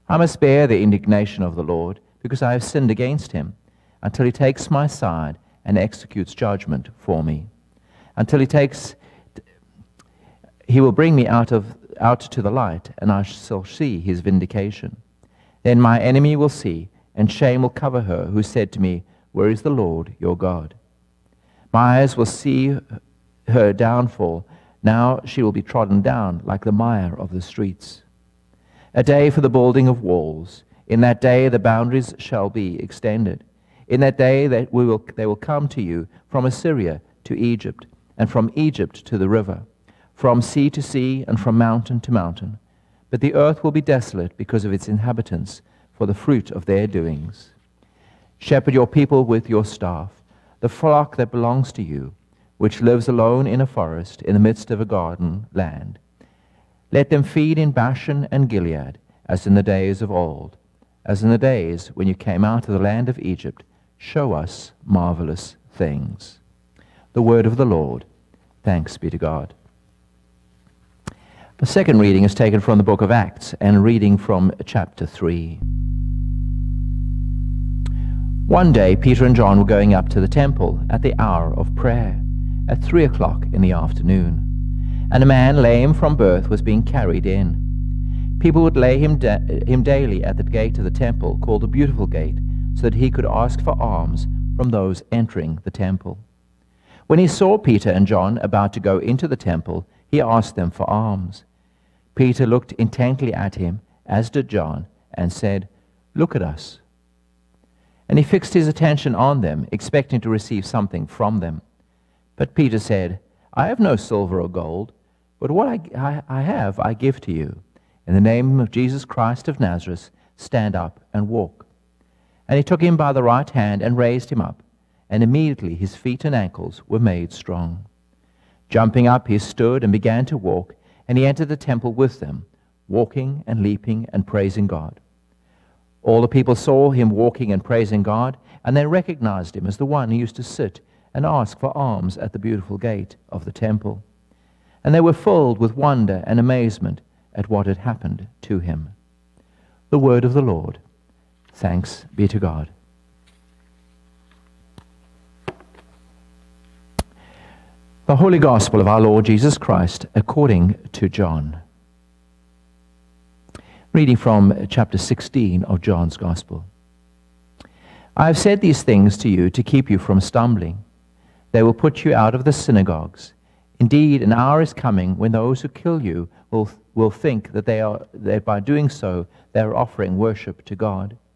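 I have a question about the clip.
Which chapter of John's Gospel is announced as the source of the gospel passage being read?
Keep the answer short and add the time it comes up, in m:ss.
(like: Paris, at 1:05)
Chapter 16, at 2:44.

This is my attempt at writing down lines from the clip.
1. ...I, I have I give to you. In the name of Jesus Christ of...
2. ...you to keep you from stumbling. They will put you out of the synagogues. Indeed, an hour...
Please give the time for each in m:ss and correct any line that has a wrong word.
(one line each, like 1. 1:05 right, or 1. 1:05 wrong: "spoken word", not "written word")
1. 1:56 right
2. 2:49 right.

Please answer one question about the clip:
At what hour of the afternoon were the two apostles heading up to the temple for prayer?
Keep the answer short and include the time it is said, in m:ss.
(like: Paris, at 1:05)
3 o'clock, at 1:22.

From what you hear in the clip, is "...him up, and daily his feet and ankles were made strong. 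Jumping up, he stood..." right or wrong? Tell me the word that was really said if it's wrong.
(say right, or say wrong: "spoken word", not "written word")
wrong: "immediately", not "daily".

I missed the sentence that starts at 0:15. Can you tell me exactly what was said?
Then my enemy will see, and shame will cover her, who said to me, Where is the Lord your God?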